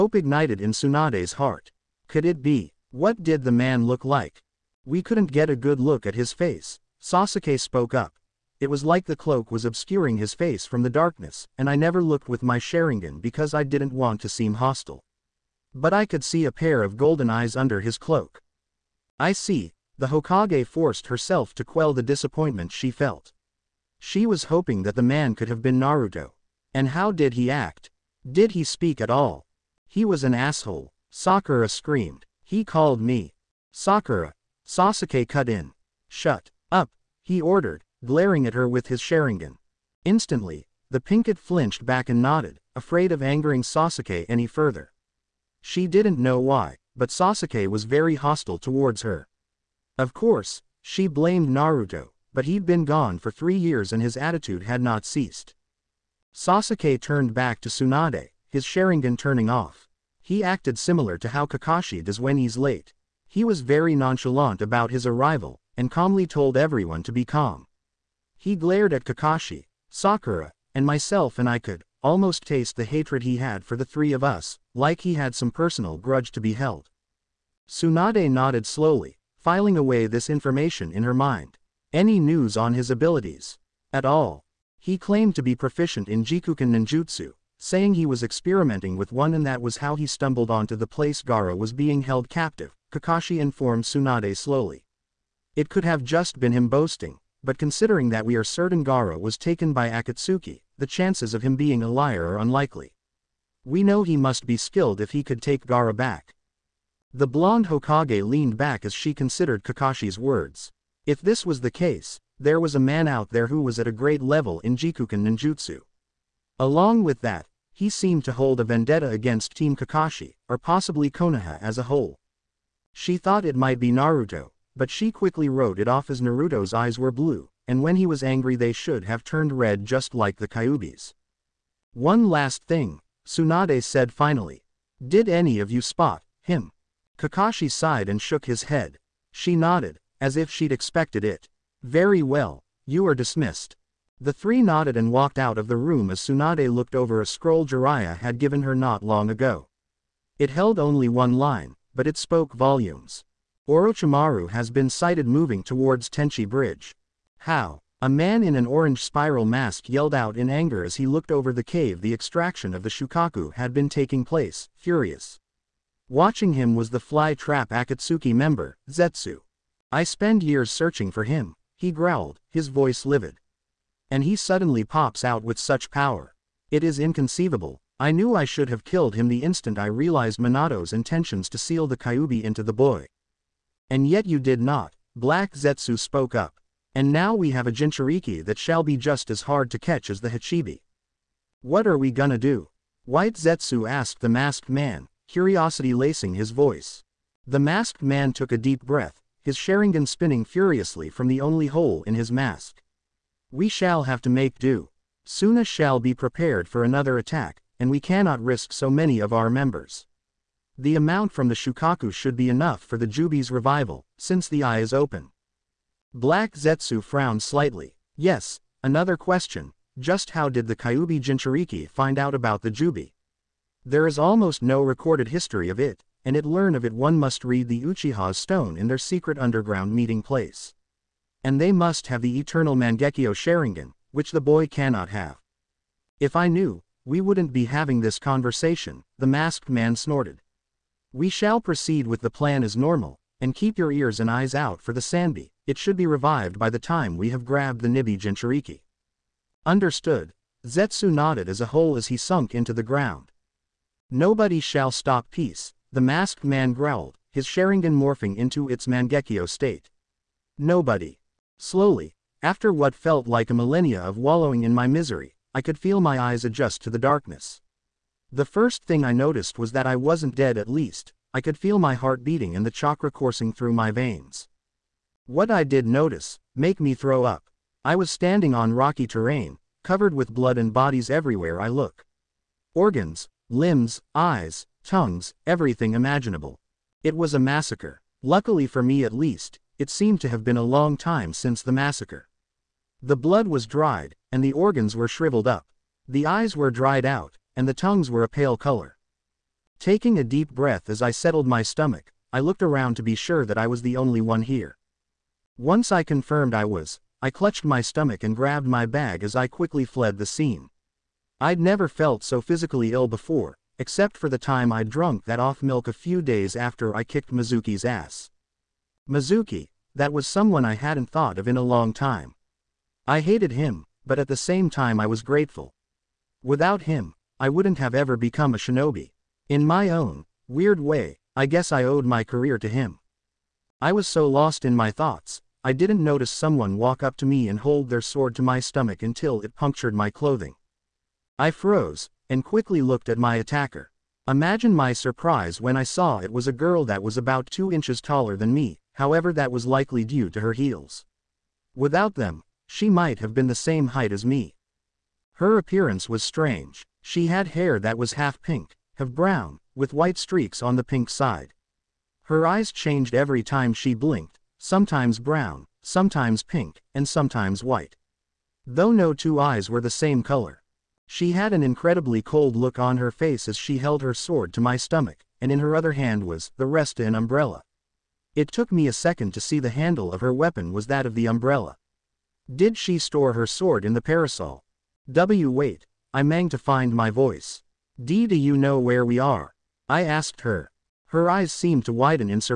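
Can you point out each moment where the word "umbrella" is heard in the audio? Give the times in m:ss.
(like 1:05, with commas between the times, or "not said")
6:17, 6:21.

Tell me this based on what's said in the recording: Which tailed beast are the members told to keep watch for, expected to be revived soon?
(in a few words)
Sanbi.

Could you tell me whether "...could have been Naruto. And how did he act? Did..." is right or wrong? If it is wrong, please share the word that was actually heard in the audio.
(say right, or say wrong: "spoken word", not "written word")
right.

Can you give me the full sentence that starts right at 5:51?
Without them, she might have been the same height as me.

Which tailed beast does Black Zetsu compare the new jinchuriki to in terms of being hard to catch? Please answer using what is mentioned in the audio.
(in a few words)
Hachibi.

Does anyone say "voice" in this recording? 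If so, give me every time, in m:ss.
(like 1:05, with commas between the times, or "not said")
2:52, 3:16, 6:27.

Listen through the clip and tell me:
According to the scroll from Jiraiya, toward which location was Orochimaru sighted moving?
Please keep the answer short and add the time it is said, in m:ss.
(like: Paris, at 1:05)
Tenchi Bridge, at 2:36.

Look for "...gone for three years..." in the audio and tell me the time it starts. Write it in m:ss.
0:52.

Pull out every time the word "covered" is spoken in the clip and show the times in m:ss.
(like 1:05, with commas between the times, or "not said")
4:39.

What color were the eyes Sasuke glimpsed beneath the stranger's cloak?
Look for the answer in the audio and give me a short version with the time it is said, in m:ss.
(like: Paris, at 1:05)
golden, at 0:16.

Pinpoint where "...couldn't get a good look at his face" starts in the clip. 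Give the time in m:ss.
0:05.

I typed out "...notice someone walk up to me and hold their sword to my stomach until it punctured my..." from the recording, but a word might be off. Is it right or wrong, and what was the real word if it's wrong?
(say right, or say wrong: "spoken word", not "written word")
right.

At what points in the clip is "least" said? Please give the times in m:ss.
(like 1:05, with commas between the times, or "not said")
4:30, 4:49.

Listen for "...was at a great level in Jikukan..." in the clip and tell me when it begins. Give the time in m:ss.
1:53.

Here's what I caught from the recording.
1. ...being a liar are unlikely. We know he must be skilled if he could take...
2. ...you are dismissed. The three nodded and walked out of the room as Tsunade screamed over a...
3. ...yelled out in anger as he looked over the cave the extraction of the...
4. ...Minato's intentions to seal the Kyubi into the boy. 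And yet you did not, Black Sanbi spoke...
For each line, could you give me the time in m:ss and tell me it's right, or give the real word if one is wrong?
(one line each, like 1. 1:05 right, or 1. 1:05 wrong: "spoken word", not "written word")
1. 1:41 right
2. 2:22 wrong: "looked", not "screamed"
3. 2:39 right
4. 3:00 wrong: "Zetsu", not "Sanbi".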